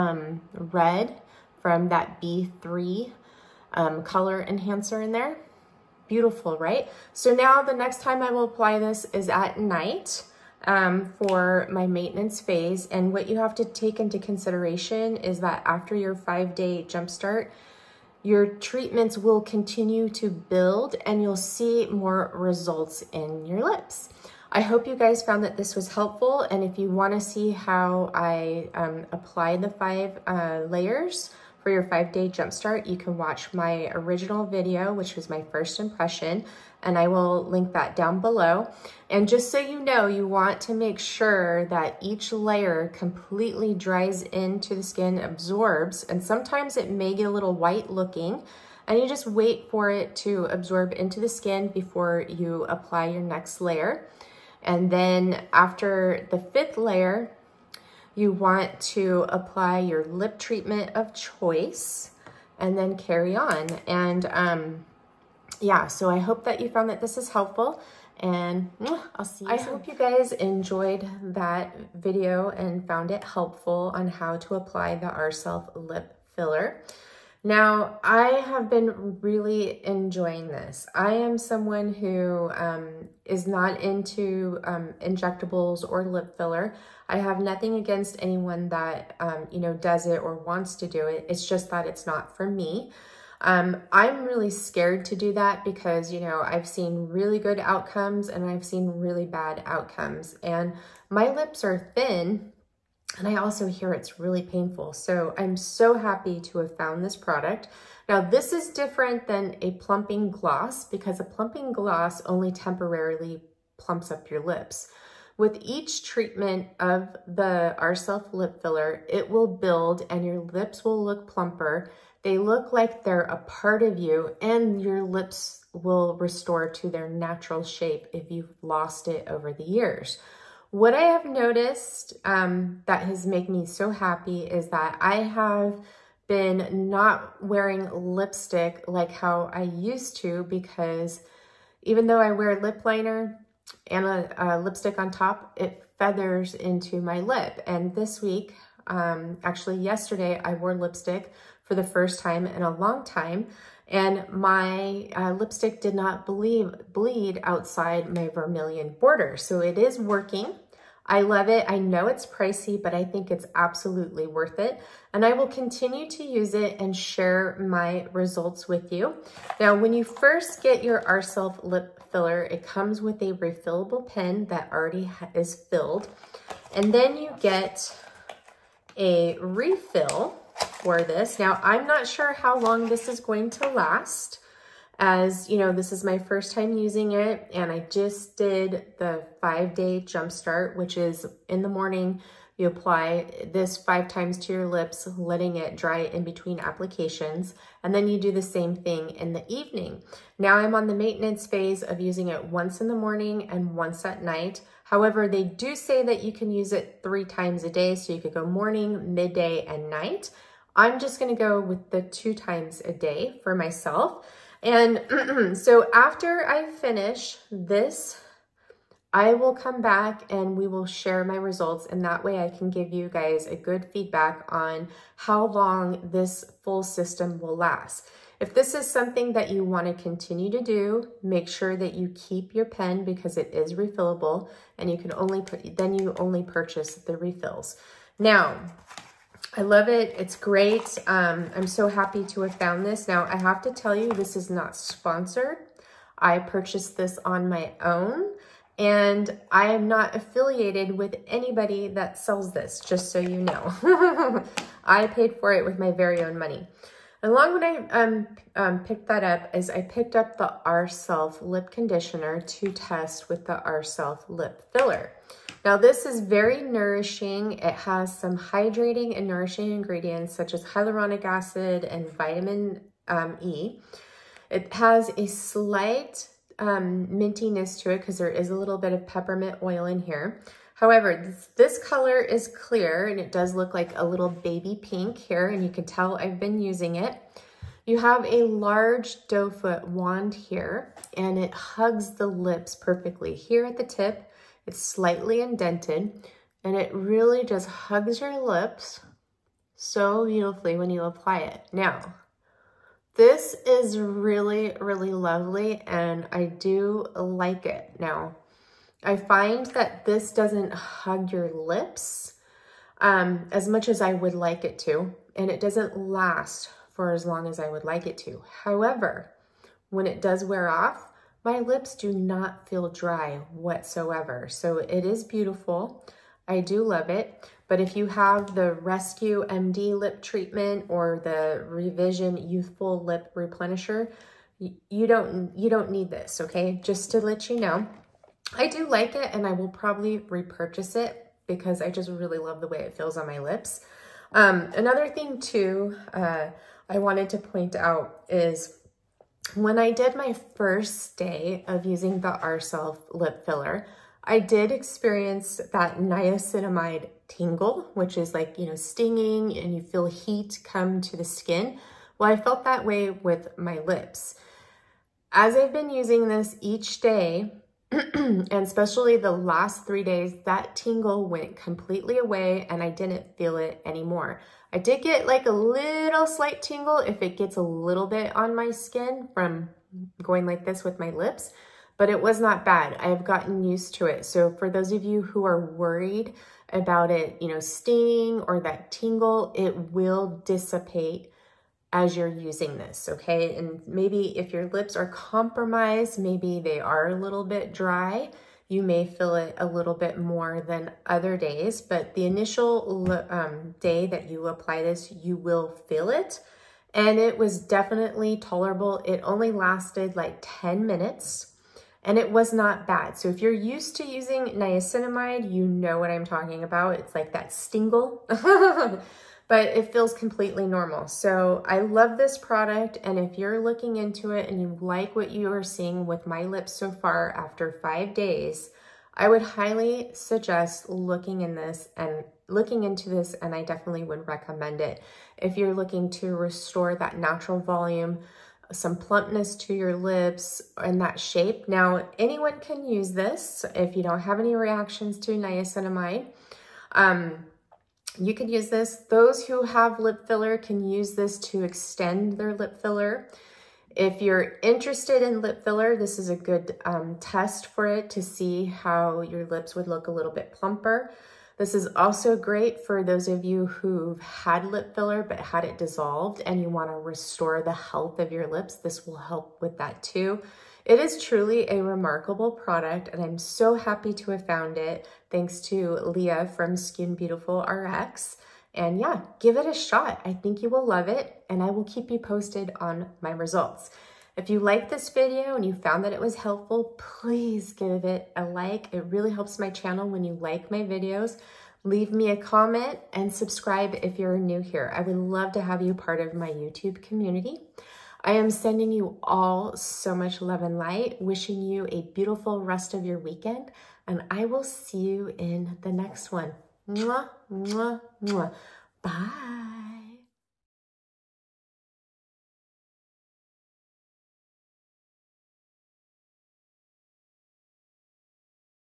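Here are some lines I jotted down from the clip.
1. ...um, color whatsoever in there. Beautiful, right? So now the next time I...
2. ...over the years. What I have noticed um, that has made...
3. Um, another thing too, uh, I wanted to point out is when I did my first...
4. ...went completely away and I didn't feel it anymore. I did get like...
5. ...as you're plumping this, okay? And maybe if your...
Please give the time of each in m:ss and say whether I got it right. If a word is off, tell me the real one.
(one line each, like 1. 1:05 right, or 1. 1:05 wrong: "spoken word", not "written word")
1. 0:03 wrong: "enhancer", not "whatsoever"
2. 2:09 right
3. 5:44 right
4. 6:11 right
5. 6:32 wrong: "using", not "plumping".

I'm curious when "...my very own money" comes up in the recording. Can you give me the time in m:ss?
4:15.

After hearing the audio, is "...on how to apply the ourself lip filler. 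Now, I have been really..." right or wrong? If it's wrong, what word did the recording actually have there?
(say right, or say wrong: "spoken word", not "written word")
right.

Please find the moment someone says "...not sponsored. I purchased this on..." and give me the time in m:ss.
4:04.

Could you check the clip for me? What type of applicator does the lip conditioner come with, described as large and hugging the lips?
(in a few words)
Doe foot wand.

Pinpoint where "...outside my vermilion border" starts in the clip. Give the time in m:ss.
2:37.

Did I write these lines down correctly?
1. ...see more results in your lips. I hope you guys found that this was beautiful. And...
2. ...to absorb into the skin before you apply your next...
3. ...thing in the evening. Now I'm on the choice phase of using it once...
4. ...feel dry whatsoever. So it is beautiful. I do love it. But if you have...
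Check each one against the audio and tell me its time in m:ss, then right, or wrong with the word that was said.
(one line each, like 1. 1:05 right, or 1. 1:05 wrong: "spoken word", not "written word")
1. 0:21 wrong: "helpful", not "beautiful"
2. 0:50 right
3. 3:18 wrong: "maintenance", not "choice"
4. 5:22 right.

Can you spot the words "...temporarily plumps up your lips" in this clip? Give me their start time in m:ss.
1:52.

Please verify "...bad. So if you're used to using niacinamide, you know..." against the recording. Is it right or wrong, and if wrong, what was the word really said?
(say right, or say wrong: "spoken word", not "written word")
right.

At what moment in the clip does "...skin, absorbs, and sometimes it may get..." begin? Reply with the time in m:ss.
0:44.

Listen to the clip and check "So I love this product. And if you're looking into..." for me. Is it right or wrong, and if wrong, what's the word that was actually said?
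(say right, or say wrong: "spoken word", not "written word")
right.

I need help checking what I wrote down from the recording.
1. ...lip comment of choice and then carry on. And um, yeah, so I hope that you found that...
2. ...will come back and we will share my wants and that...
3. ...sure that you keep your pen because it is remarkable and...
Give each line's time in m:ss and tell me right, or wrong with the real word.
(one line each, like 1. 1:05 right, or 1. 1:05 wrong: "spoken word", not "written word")
1. 1:00 wrong: "treatment", not "comment"
2. 3:39 wrong: "results", not "wants"
3. 3:51 wrong: "refillable", not "remarkable".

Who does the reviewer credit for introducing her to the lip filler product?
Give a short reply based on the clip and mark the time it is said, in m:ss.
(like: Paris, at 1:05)
Leah, at 7:55.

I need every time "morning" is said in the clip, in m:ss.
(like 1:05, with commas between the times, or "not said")
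3:11, 3:22, 3:28.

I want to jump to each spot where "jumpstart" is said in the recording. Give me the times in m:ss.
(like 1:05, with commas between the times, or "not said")
0:16, 0:32, 3:10.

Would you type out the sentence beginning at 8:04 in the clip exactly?
If you liked this video and you found that it was helpful, please give it a like.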